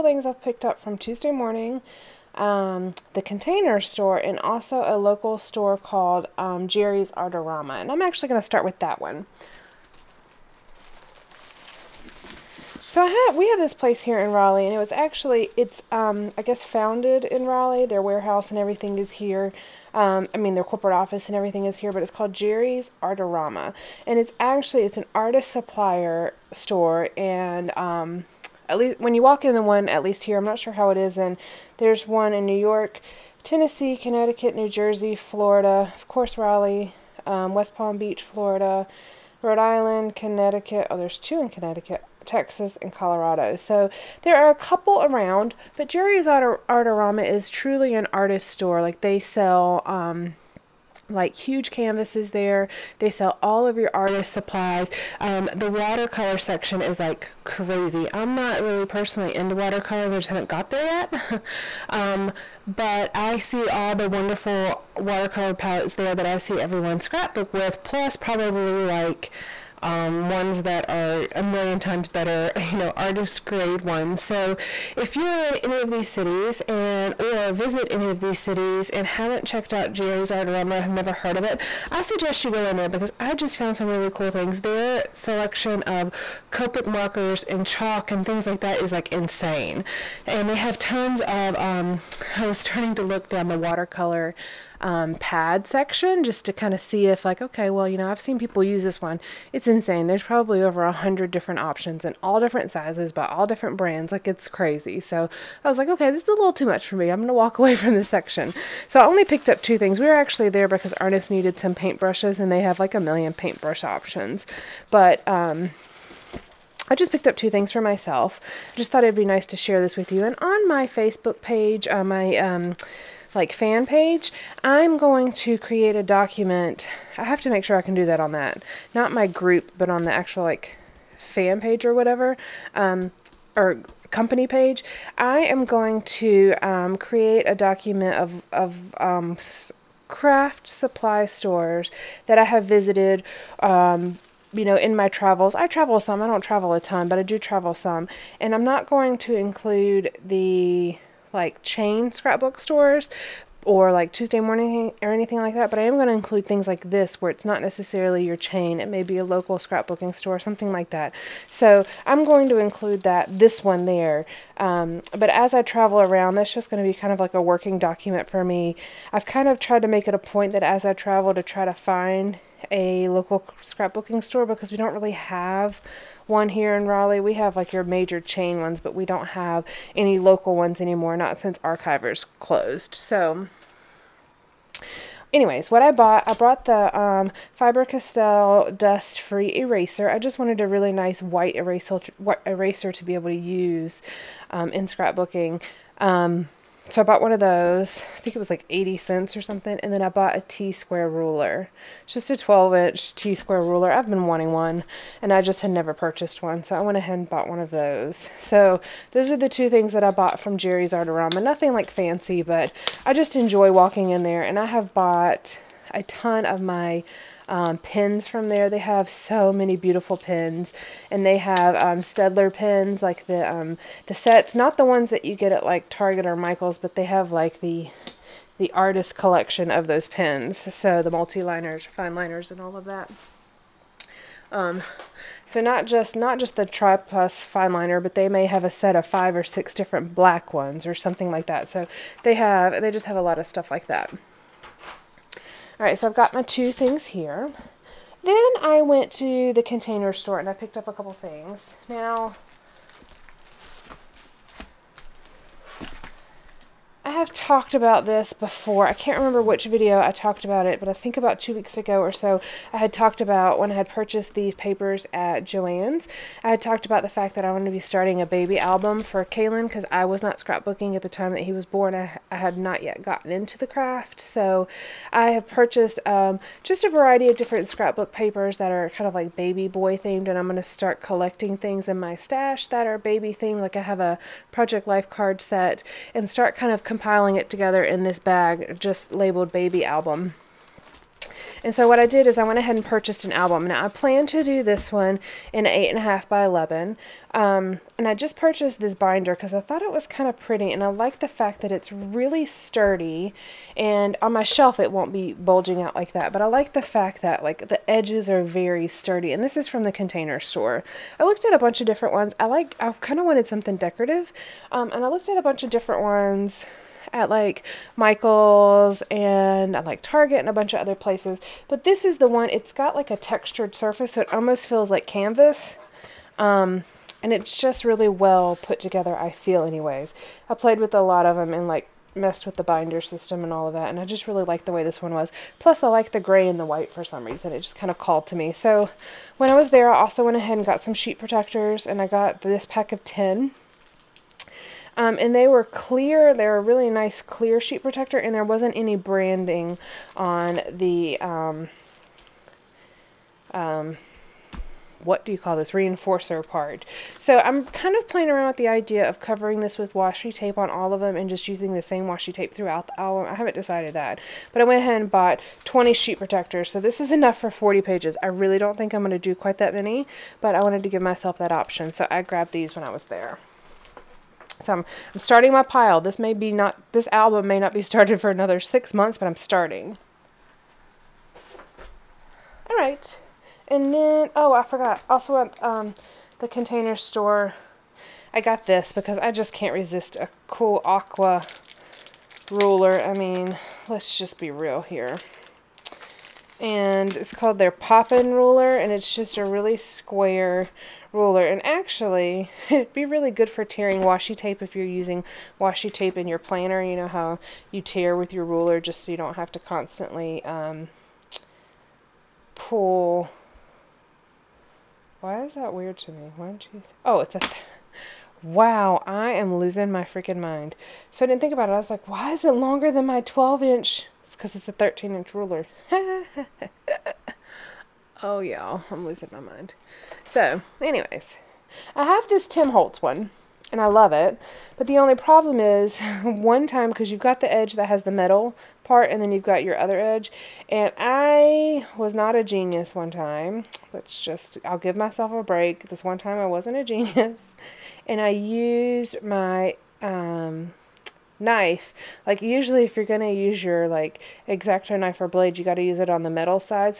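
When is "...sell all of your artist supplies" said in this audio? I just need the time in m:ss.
0:53.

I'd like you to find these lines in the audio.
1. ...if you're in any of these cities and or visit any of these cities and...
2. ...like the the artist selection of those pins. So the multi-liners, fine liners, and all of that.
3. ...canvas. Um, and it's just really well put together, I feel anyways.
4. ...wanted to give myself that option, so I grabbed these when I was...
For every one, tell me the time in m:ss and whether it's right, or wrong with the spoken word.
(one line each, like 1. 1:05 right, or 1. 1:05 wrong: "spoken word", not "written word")
1. 1:14 right
2. 3:47 wrong: "collection", not "selection"
3. 5:25 right
4. 6:10 right.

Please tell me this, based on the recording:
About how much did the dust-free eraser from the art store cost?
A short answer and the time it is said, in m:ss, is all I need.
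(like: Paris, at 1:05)
80 cents, at 3:18.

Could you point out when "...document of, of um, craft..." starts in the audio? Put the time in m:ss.
2:17.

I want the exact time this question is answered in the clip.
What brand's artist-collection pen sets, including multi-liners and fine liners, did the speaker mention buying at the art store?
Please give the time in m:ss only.
3:41.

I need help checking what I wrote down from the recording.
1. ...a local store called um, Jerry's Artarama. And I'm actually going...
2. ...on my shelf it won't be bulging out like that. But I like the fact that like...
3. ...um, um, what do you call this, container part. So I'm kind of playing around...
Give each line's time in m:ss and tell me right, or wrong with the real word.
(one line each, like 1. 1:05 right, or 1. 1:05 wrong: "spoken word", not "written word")
1. 0:04 right
2. 5:04 right
3. 5:51 wrong: "reinforcer", not "container".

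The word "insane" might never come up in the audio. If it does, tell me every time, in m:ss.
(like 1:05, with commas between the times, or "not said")
1:29, 1:39.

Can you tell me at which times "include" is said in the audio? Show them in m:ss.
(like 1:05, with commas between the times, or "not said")
2:29, 2:36, 2:42.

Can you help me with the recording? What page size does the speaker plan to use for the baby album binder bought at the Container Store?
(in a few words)
8.5 by 11.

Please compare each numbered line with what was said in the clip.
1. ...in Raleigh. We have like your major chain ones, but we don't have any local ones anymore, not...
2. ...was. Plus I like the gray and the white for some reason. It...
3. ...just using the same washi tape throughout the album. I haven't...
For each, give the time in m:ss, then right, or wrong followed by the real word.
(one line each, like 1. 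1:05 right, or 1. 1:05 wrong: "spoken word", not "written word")
1. 2:56 right
2. 5:35 right
3. 6:01 right.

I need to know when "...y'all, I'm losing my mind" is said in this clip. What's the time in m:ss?
7:08.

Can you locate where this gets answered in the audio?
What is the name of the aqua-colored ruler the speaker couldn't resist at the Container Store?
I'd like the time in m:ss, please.
6:37.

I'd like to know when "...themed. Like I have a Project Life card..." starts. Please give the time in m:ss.
4:43.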